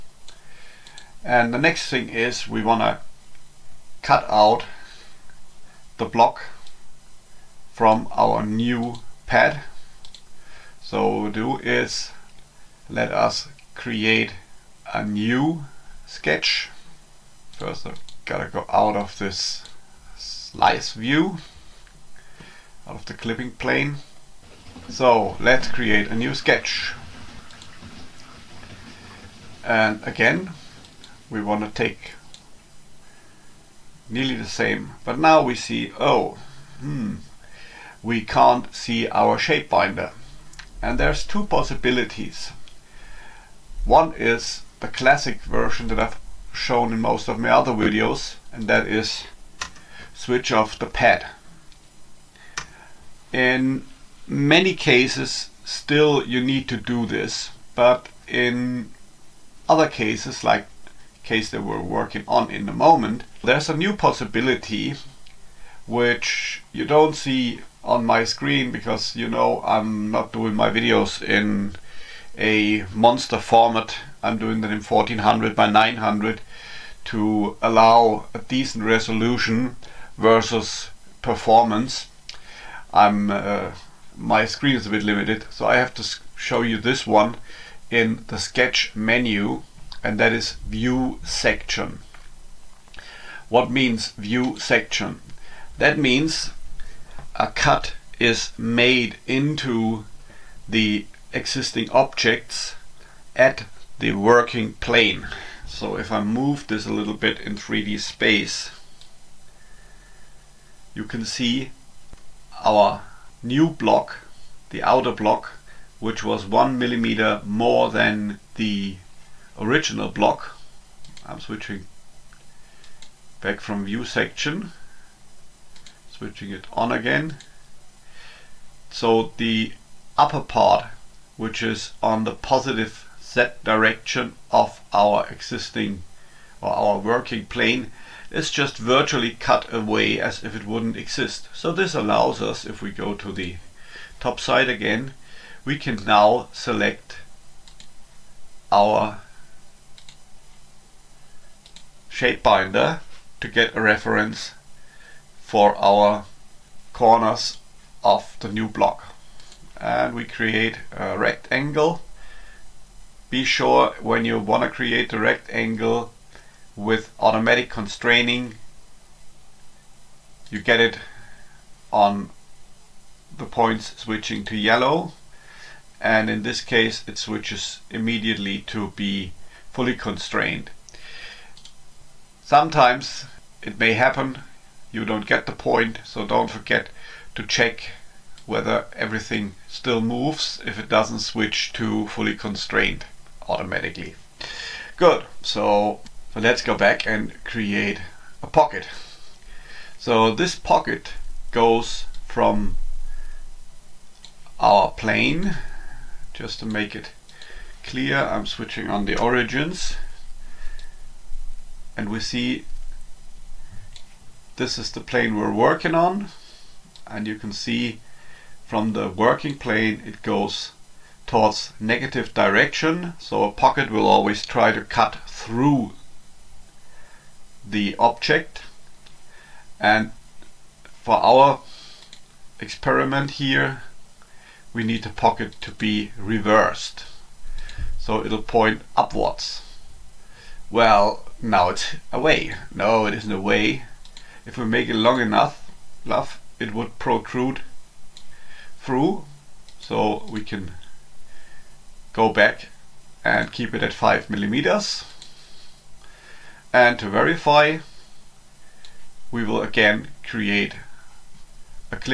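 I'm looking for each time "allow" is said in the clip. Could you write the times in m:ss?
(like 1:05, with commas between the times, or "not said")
1:17, 2:21.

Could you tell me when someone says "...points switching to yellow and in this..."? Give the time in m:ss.
2:53.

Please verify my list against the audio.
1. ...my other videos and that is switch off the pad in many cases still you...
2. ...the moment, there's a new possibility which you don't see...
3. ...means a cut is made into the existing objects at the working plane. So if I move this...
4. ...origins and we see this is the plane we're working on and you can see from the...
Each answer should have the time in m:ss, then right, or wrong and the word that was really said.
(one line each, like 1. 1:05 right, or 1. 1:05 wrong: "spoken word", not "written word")
1. 0:47 right
2. 1:02 right
3. 1:35 right
4. 3:29 right.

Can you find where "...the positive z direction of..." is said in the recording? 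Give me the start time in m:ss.
2:12.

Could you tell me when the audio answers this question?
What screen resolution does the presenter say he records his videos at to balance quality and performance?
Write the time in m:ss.
1:14.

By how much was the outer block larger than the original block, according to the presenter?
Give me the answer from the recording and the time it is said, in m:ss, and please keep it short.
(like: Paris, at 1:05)
1 millimeter, at 1:56.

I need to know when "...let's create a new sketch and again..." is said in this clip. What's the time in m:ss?
0:25.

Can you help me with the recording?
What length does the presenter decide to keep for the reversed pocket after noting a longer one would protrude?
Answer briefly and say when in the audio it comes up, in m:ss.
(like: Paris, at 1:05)
5 millimeters, at 4:13.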